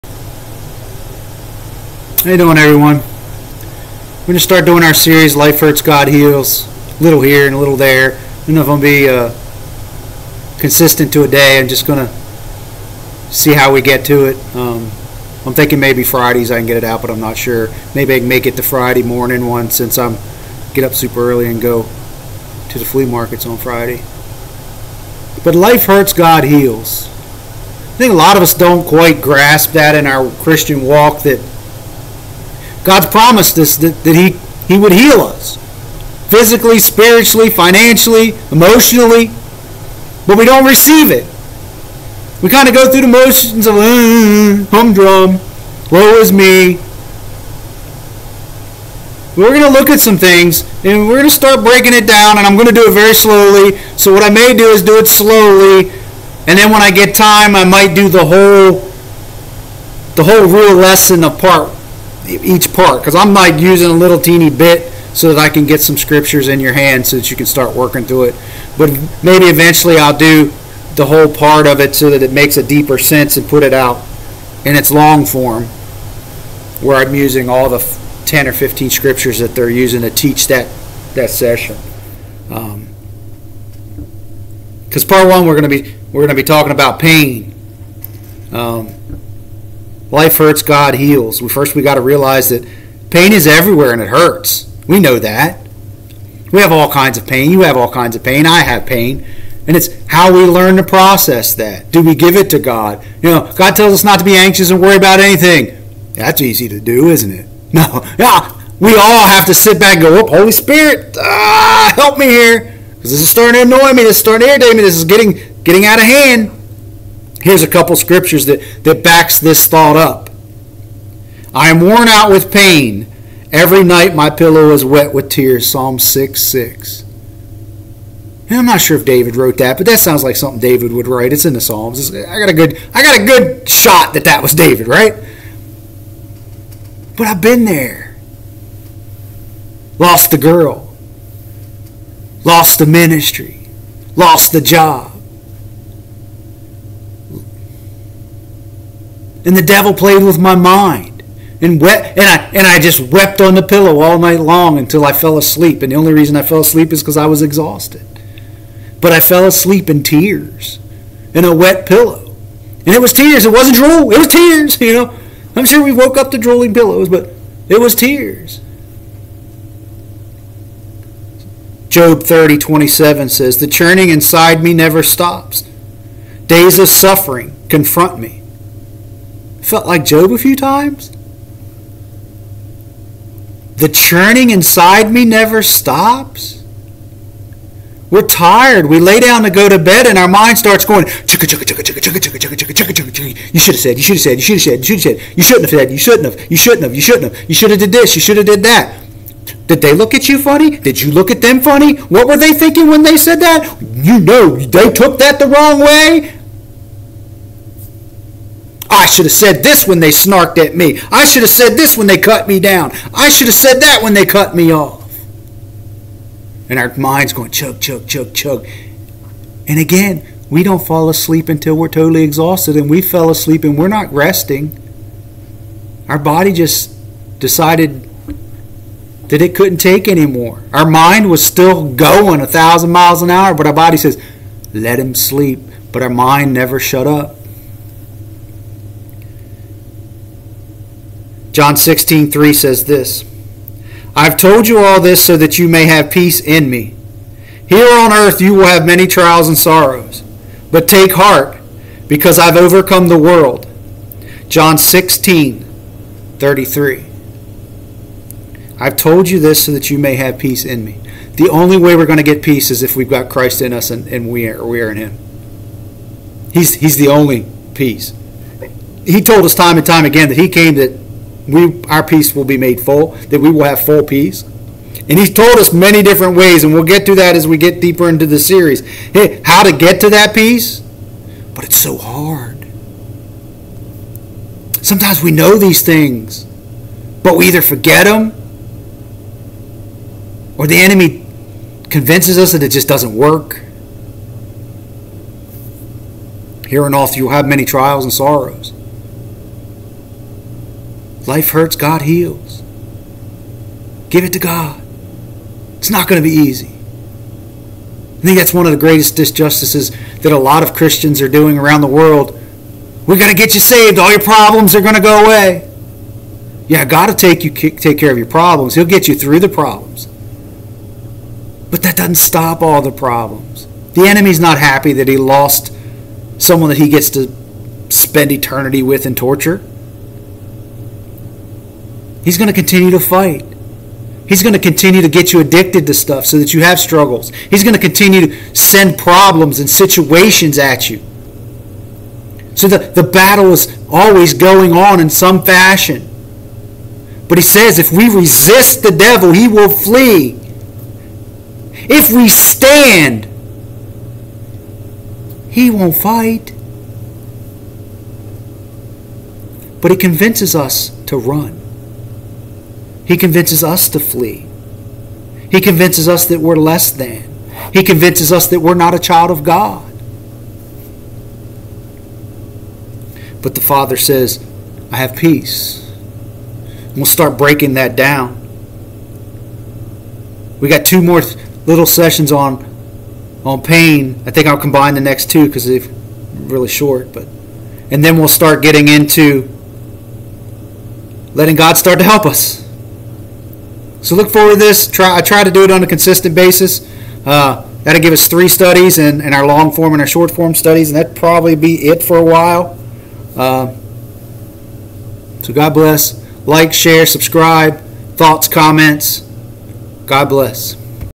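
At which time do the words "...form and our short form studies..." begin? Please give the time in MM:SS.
06:39.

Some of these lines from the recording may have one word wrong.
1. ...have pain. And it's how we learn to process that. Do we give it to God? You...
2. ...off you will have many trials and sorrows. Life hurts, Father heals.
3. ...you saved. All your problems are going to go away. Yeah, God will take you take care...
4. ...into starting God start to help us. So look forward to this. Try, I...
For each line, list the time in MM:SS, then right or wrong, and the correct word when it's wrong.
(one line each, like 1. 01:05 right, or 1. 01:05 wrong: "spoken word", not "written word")
1. 01:38 right
2. 04:56 wrong: "God", not "Father"
3. 05:13 right
4. 06:28 wrong: "letting", not "starting".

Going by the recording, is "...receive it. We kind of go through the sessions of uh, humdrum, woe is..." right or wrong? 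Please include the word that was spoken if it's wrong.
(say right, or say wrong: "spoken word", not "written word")
wrong: "motions", not "sessions".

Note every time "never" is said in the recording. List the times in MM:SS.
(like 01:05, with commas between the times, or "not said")
02:54, 03:05, 03:56.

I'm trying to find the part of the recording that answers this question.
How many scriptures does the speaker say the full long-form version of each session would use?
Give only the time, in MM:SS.
01:18.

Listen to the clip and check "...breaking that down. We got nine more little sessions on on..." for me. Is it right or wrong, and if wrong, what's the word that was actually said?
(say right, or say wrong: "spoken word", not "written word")
wrong: "two", not "nine".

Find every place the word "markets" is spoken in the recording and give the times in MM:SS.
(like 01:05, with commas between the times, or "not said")
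00:23.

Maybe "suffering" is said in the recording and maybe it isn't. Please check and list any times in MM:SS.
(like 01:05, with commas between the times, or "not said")
02:56.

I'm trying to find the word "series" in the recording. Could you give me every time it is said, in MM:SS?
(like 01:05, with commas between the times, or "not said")
00:04, 04:38.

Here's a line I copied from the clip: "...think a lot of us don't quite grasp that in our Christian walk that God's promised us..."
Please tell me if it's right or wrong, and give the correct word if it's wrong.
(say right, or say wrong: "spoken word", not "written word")
right.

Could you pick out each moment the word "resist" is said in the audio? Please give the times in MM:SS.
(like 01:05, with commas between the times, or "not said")
05:48.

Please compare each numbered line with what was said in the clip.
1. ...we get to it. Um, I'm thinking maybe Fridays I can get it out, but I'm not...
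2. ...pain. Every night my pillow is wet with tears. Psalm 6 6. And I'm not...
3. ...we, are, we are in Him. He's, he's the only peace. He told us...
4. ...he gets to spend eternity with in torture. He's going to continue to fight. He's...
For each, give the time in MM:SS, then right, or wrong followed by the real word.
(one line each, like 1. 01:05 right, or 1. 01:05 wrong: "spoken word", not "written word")
1. 00:13 right
2. 02:02 right
3. 04:24 right
4. 05:26 right.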